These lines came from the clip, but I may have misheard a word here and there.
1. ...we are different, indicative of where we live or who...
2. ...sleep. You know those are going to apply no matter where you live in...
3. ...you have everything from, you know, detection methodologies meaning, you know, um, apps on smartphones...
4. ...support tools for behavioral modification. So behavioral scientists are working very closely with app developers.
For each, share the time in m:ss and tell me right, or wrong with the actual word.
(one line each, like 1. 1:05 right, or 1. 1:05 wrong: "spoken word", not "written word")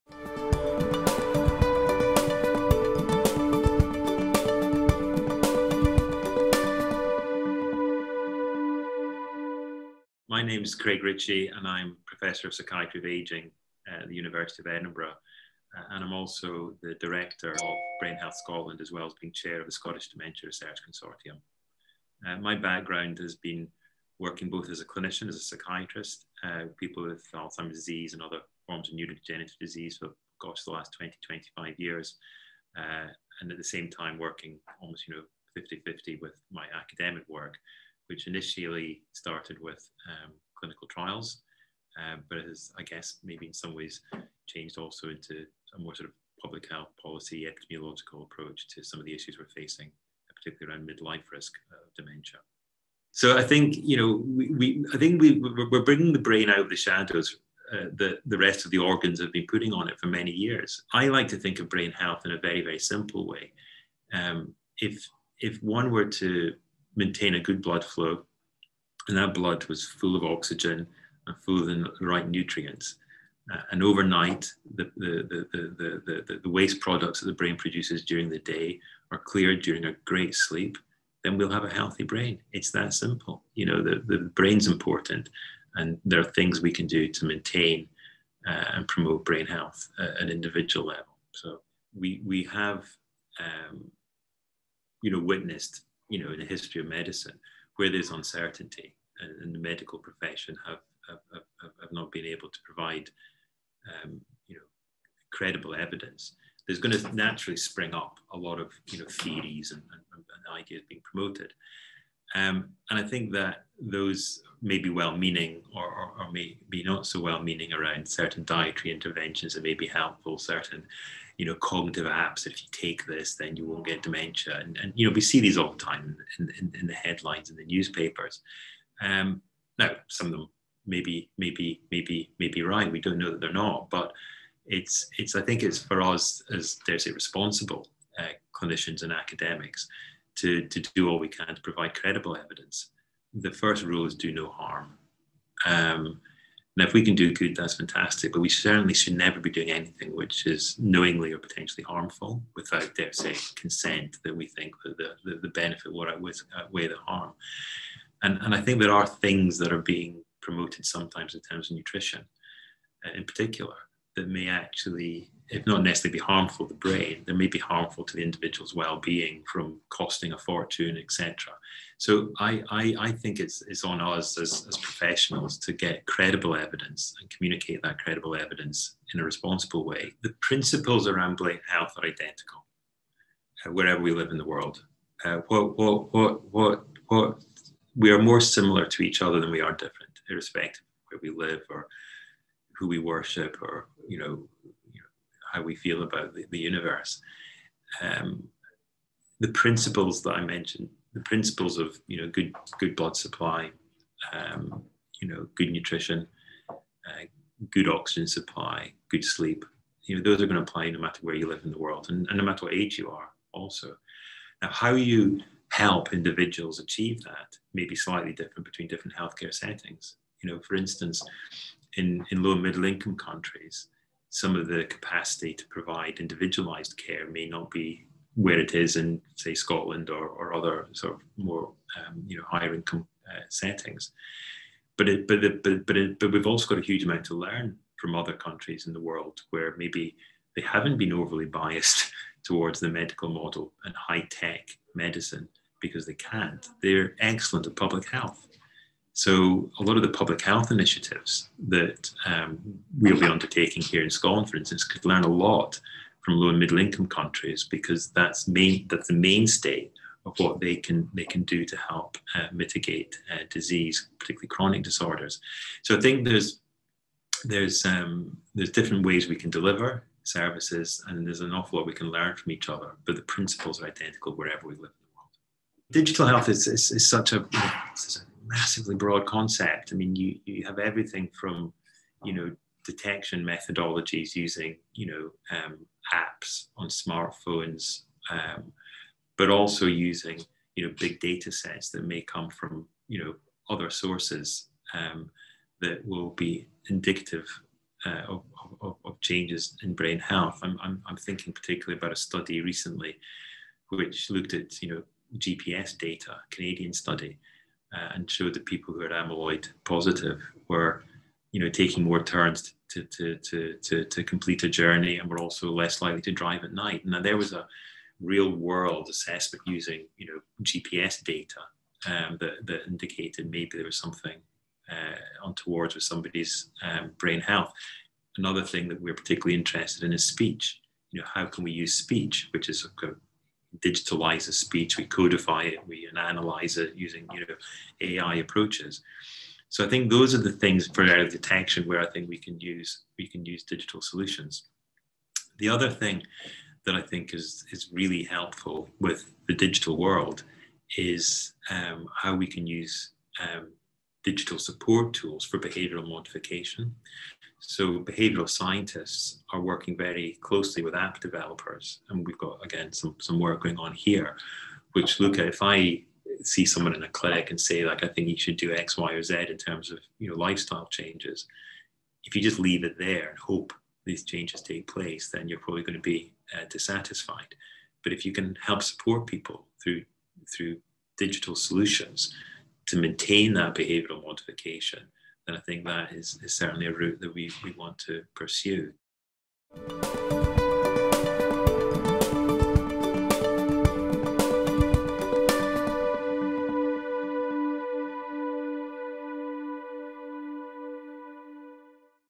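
1. 3:09 wrong: "irrespective", not "indicative"
2. 3:29 right
3. 4:40 wrong: "using", not "meaning"
4. 5:54 right.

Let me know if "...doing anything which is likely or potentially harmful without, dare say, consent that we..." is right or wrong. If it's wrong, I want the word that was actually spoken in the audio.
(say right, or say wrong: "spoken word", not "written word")
wrong: "knowingly", not "likely".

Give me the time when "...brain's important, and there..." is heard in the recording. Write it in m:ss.
1:24.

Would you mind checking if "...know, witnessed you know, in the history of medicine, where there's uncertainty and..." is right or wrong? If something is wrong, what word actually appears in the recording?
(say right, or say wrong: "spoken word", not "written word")
right.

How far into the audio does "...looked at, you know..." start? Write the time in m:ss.
5:04.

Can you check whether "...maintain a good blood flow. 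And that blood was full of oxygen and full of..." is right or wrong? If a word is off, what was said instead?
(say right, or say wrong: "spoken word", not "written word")
right.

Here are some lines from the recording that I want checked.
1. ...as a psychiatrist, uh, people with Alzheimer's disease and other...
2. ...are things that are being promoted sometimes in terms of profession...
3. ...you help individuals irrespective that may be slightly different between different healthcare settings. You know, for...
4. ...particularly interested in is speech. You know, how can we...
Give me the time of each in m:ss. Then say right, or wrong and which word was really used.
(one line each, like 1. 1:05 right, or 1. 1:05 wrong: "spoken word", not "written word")
1. 0:25 right
2. 2:38 wrong: "nutrition", not "profession"
3. 3:34 wrong: "achieve", not "irrespective"
4. 5:29 right.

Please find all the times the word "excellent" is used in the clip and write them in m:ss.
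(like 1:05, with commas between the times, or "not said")
4:07.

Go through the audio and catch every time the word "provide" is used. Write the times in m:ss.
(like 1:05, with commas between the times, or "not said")
1:42, 2:21, 3:45.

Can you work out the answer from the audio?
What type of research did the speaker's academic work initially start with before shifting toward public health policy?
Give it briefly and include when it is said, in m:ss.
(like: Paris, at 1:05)
clinical trials, at 0:40.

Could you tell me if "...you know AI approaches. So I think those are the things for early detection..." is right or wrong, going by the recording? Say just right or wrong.
right.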